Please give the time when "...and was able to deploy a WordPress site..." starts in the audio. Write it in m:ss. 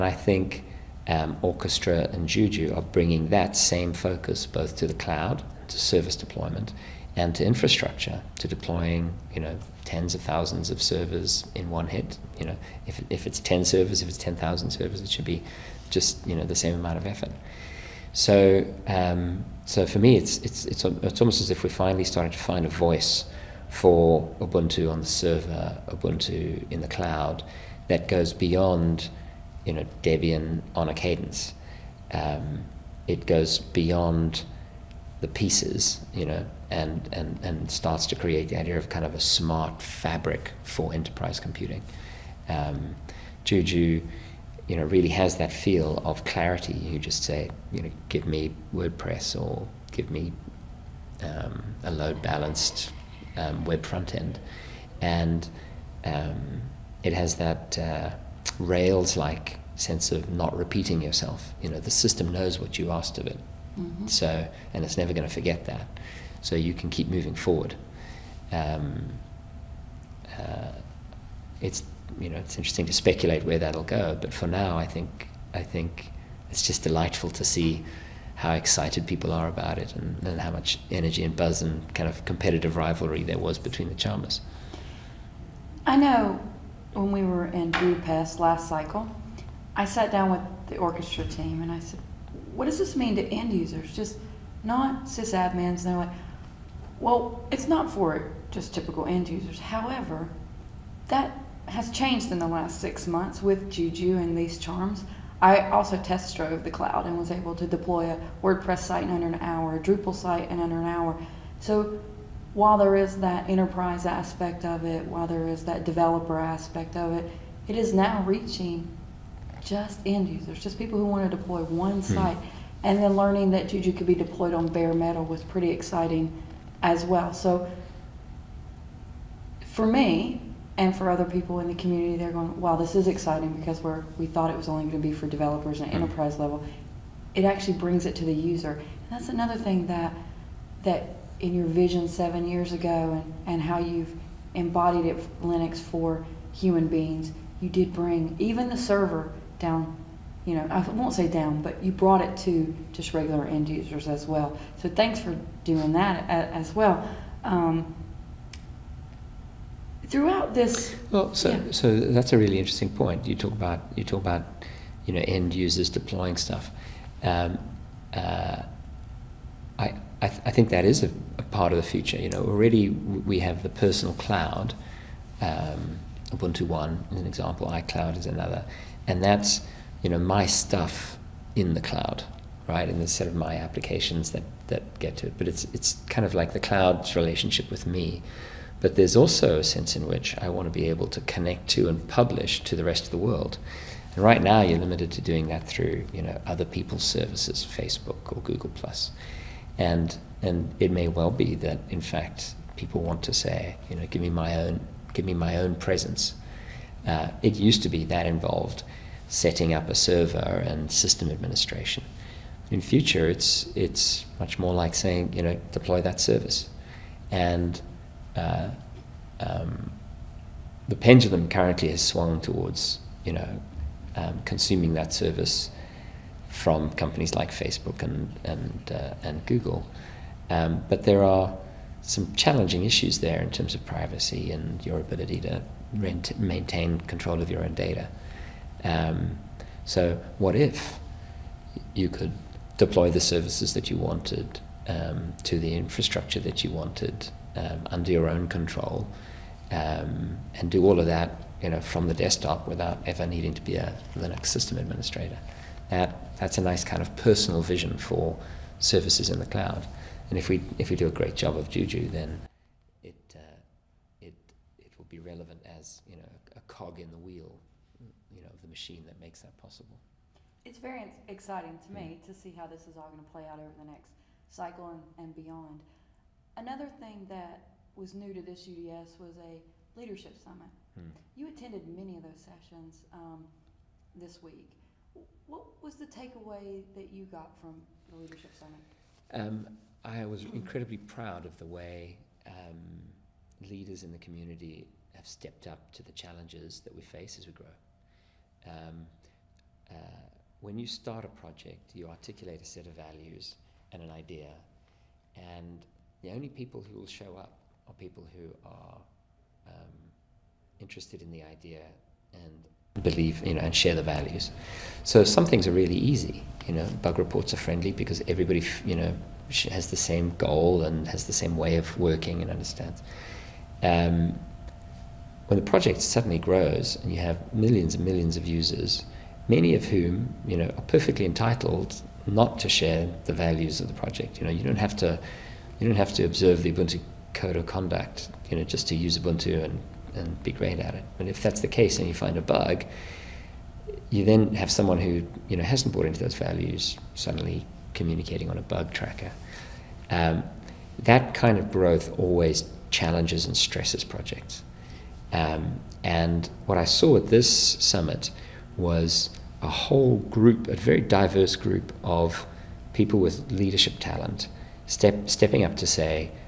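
1:47.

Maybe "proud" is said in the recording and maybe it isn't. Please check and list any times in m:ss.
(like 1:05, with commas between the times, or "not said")
4:50.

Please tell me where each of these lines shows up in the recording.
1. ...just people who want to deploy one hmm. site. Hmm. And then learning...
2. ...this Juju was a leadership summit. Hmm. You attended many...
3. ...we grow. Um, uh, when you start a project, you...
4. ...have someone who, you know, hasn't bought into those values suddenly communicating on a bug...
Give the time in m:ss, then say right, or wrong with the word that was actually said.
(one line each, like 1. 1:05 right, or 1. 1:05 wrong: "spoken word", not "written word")
1. 2:00 right
2. 4:38 wrong: "UDS", not "Juju"
3. 4:57 right
4. 5:44 right.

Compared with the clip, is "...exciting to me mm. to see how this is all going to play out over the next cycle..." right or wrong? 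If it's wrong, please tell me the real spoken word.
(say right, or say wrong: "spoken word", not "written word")
right.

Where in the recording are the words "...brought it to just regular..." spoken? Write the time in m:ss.
2:31.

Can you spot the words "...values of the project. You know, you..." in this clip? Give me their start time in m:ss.
5:33.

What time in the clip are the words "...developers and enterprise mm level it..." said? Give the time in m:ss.
2:15.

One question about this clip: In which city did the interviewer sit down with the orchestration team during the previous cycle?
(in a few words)
Budapest.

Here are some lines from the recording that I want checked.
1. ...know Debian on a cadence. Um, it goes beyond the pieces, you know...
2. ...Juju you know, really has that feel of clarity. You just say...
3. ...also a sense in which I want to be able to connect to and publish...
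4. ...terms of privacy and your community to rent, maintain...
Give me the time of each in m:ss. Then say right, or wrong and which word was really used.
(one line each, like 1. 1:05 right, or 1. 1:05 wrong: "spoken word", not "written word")
1. 0:29 right
2. 0:43 right
3. 3:09 right
4. 3:53 wrong: "ability", not "community".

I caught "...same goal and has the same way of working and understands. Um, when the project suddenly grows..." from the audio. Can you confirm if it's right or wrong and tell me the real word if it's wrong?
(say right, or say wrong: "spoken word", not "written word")
right.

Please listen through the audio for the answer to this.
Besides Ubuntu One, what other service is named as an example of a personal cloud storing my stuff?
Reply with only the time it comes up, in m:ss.
2:57.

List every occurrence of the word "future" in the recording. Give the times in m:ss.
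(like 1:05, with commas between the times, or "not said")
2:51, 3:32.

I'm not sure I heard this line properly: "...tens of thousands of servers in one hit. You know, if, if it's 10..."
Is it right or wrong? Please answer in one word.
right.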